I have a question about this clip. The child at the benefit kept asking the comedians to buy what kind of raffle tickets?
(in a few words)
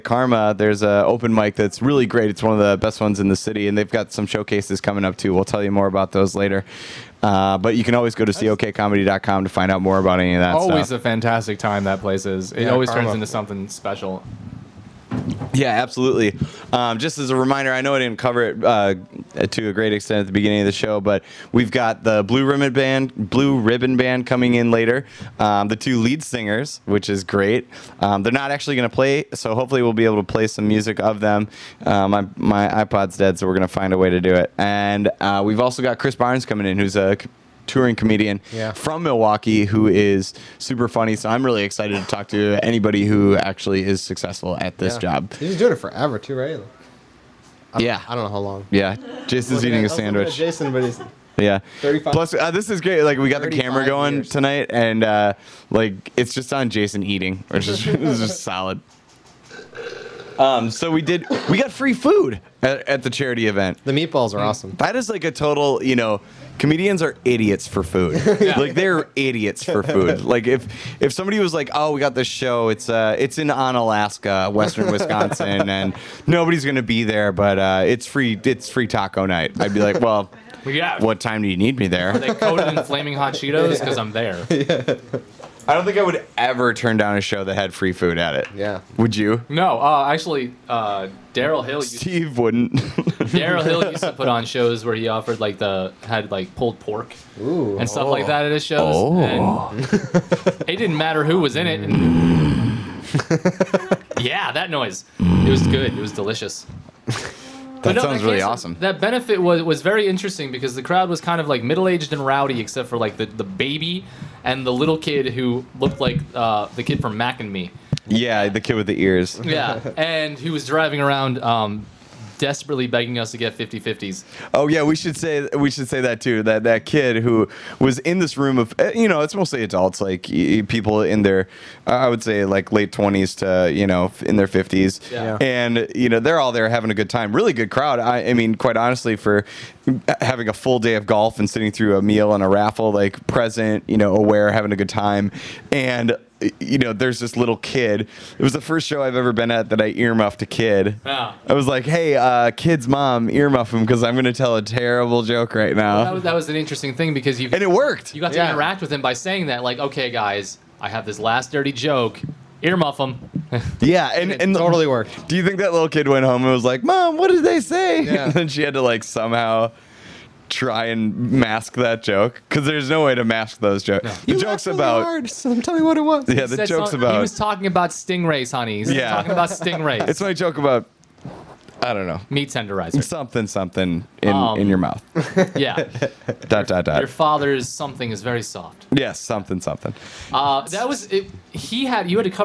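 50-50s.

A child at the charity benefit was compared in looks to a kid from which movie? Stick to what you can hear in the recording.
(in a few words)
Mac and Me.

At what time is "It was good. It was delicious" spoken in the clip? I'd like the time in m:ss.
1:45.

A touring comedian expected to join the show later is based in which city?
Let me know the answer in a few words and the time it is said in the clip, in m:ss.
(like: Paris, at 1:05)
Milwaukee, at 0:39.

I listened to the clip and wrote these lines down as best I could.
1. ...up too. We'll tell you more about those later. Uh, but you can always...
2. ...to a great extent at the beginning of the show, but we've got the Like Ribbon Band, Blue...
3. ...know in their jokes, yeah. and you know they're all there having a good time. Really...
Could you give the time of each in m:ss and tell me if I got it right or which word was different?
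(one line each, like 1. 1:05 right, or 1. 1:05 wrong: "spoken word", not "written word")
1. 0:05 right
2. 0:19 wrong: "Blue", not "Like"
3. 2:13 wrong: "fifties", not "jokes".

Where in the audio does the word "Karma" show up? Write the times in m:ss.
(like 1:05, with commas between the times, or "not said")
0:00, 0:12.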